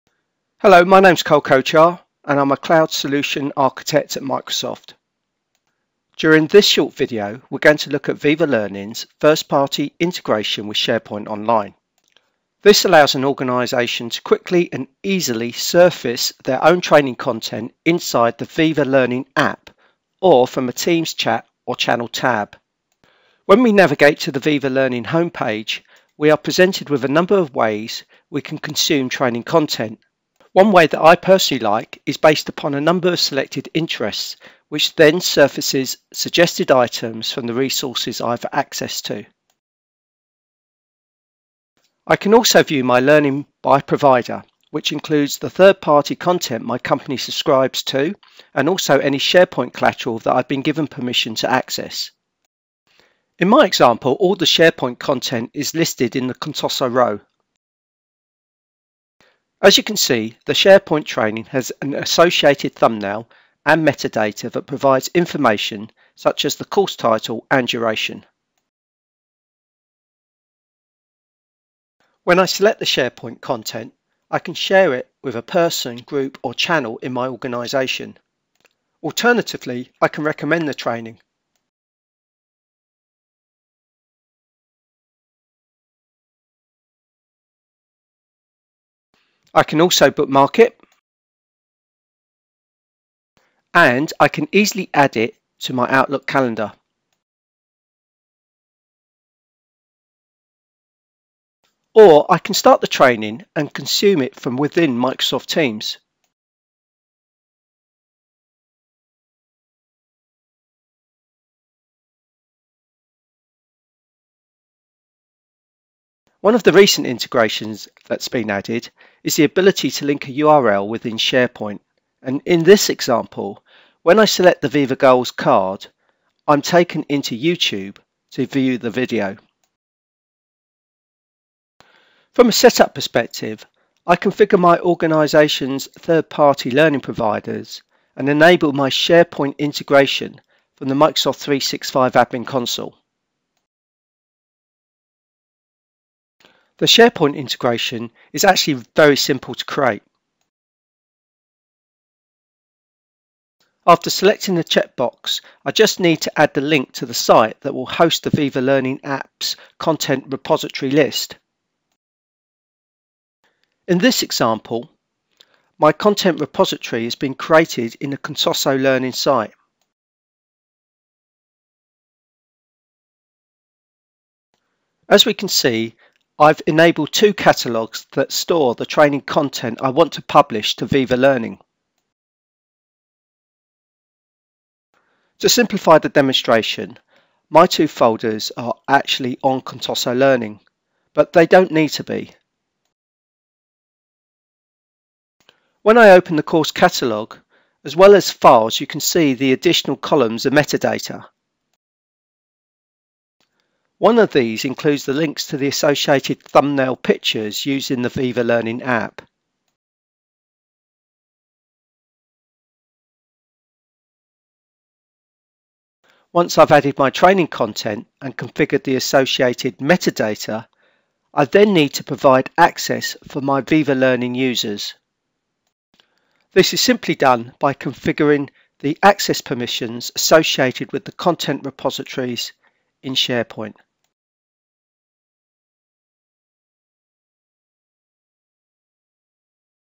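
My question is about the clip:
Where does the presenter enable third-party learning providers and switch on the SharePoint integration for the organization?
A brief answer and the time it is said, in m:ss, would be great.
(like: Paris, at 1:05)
Microsoft 365 Admin Console, at 2:20.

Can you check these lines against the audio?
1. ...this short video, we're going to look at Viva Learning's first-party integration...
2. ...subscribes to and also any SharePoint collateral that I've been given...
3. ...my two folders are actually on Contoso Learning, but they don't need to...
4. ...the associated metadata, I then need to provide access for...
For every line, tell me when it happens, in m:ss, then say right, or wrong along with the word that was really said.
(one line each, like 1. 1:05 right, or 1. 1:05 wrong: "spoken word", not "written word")
1. 0:06 right
2. 0:47 right
3. 3:07 right
4. 3:38 right.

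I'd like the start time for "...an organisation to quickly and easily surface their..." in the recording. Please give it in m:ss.
0:13.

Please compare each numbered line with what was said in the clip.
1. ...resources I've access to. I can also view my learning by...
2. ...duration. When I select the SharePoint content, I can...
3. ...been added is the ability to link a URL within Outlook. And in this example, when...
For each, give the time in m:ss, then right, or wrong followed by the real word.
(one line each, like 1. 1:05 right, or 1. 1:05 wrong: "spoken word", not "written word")
1. 0:37 right
2. 1:07 right
3. 1:58 wrong: "SharePoint", not "Outlook".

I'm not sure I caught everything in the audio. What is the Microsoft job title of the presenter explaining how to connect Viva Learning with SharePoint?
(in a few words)
Cloud Solution Architect.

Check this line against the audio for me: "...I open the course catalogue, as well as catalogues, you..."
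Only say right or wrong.
wrong.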